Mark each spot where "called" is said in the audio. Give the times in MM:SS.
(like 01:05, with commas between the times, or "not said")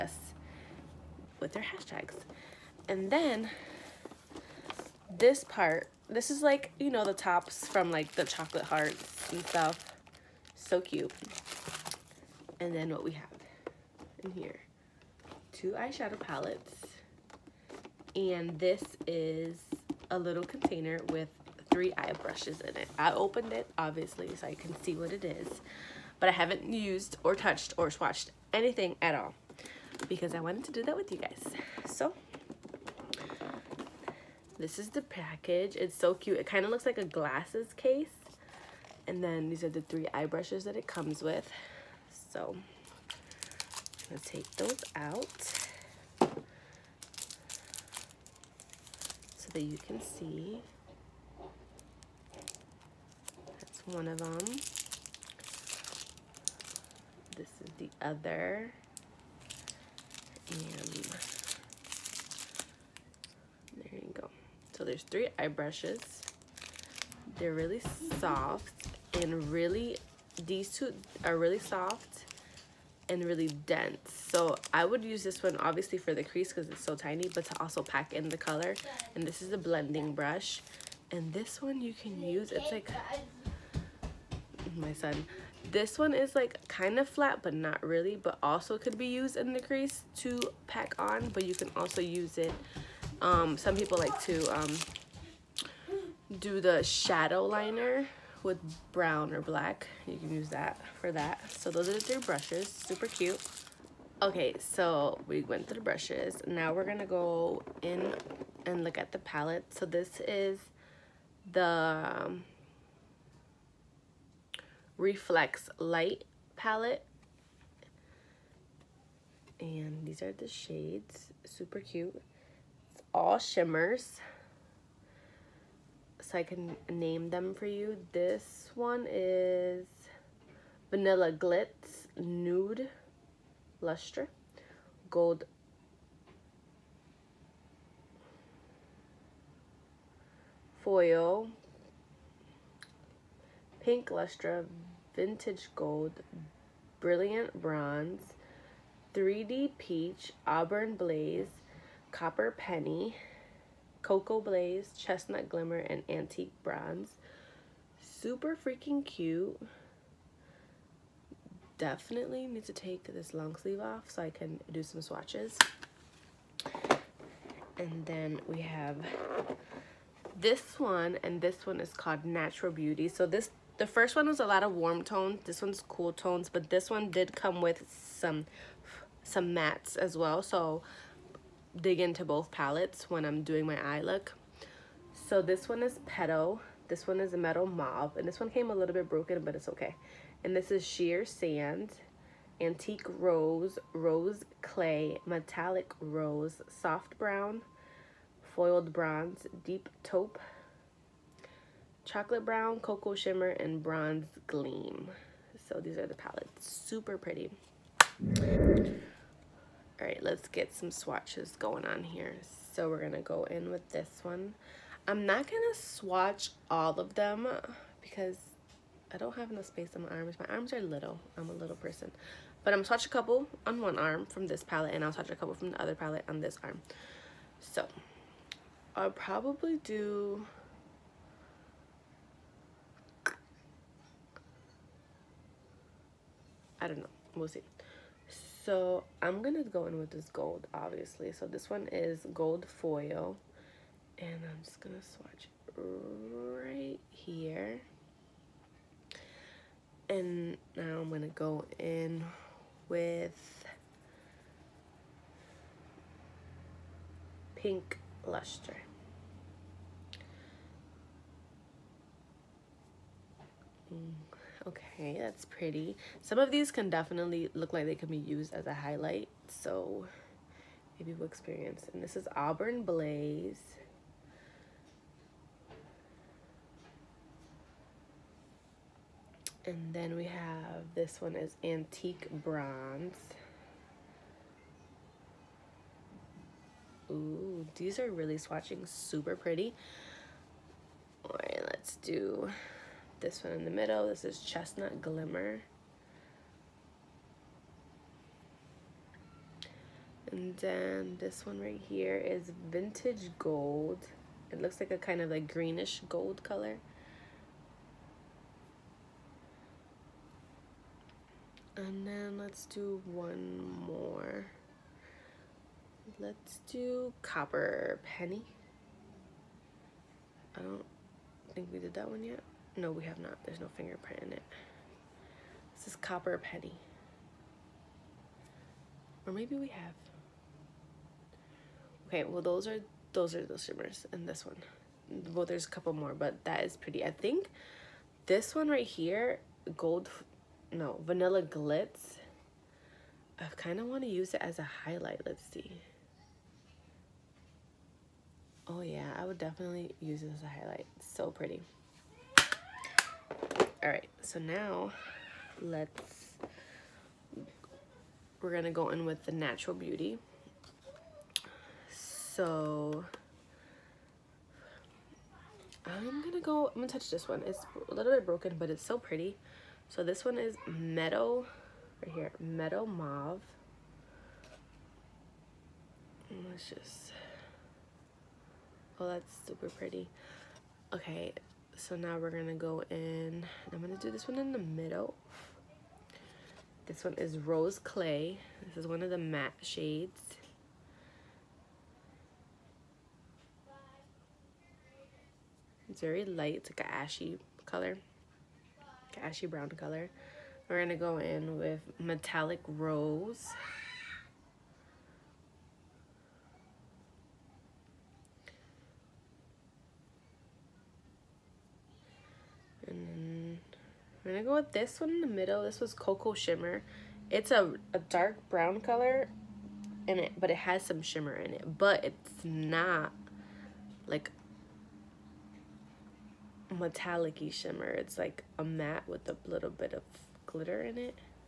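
02:51.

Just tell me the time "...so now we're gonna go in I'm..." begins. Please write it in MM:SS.
06:21.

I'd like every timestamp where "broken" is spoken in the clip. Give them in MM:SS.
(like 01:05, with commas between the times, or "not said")
03:09, 06:08.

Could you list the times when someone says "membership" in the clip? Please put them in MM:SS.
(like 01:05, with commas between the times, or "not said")
not said.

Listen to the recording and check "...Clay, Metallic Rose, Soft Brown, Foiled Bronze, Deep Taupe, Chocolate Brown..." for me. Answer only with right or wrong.
right.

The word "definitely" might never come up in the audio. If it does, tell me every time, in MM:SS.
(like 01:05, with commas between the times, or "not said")
02:41, 04:26, 05:49.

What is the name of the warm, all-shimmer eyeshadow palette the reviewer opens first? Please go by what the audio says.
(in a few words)
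Reflex Light.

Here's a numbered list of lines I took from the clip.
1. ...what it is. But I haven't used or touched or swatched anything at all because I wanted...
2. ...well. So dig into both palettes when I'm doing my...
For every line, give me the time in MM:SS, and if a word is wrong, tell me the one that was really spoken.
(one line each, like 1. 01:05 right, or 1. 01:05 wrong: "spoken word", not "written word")
1. 00:24 right
2. 03:00 right.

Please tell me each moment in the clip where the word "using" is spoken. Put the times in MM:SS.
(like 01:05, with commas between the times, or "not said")
not said.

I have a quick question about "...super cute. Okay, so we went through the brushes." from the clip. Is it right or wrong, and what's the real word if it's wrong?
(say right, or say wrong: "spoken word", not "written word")
right.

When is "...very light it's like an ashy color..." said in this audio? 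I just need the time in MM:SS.
06:36.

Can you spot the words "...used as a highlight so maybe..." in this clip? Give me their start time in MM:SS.
04:28.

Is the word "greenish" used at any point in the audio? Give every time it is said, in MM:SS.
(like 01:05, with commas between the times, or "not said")
05:05.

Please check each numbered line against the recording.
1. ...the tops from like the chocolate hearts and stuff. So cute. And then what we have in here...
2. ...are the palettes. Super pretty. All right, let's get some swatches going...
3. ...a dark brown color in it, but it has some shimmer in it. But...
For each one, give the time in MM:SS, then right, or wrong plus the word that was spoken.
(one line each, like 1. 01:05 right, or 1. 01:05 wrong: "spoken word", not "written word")
1. 00:07 right
2. 03:25 right
3. 06:57 right.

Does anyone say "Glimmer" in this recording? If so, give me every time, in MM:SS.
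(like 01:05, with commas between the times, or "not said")
02:35, 04:55.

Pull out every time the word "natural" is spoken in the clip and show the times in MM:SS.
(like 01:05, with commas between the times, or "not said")
02:52, 05:59.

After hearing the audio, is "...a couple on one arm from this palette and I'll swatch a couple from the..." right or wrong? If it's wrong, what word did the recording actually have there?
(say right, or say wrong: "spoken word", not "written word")
right.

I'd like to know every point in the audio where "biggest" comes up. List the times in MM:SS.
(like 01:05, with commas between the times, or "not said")
not said.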